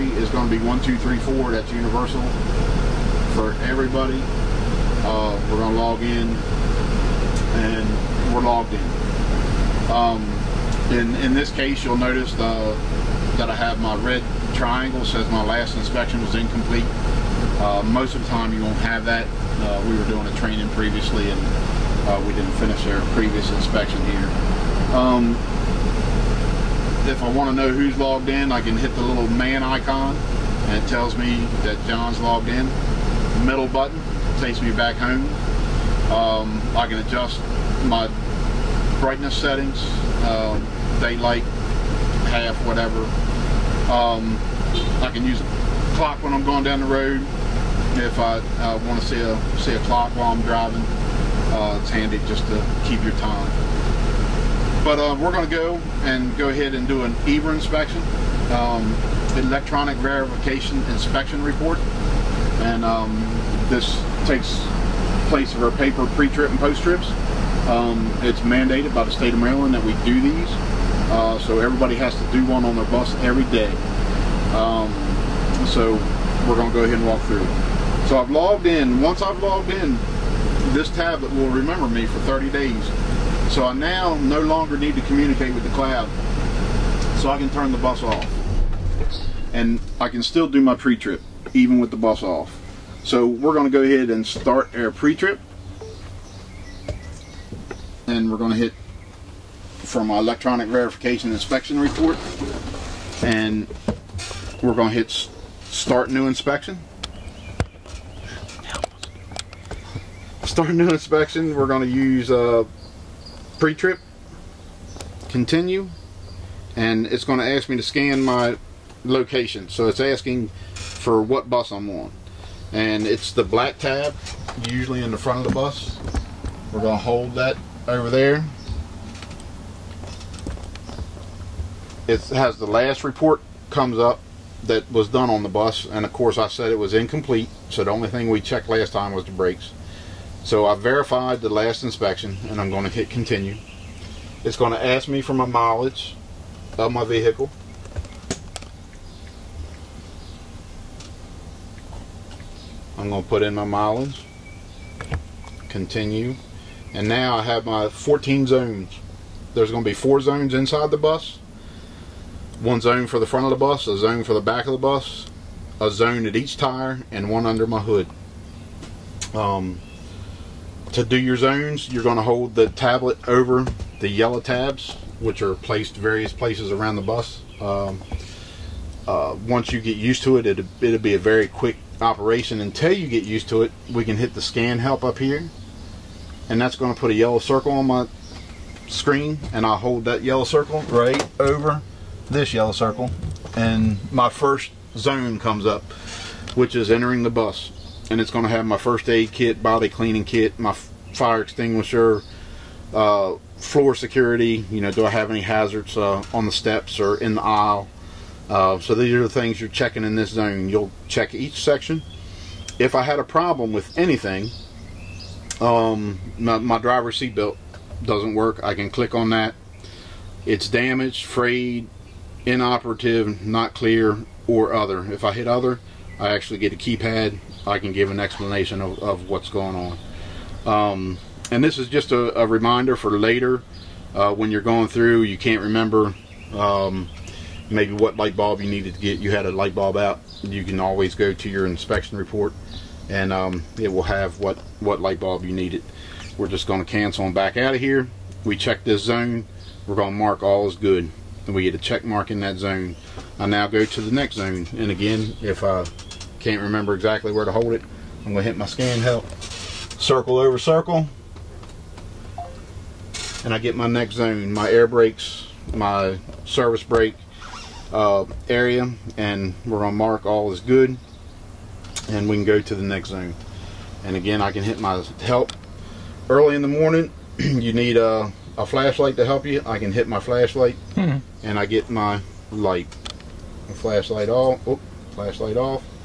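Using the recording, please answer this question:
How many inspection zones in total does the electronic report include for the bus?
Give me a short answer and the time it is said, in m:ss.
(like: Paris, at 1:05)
14, at 2:37.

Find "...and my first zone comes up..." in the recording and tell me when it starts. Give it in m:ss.
3:13.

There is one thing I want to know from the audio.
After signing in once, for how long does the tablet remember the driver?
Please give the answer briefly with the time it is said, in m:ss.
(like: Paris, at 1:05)
30 days, at 1:22.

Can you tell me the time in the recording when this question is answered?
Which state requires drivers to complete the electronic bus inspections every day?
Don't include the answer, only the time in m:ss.
1:09.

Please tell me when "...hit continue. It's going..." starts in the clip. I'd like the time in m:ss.
2:22.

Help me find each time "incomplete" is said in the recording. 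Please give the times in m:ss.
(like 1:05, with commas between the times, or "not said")
0:16, 2:16.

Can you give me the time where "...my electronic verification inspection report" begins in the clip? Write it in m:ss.
1:40.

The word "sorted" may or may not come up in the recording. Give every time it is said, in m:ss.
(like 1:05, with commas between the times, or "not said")
not said.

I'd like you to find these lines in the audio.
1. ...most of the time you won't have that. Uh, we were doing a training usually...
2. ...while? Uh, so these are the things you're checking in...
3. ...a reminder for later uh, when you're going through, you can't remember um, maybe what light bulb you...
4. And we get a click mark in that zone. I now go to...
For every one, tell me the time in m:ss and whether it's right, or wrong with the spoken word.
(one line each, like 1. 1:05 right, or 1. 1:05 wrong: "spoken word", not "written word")
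1. 0:17 wrong: "previously", not "usually"
2. 3:27 wrong: "aisle", not "while"
3. 3:52 right
4. 4:11 wrong: "check", not "click".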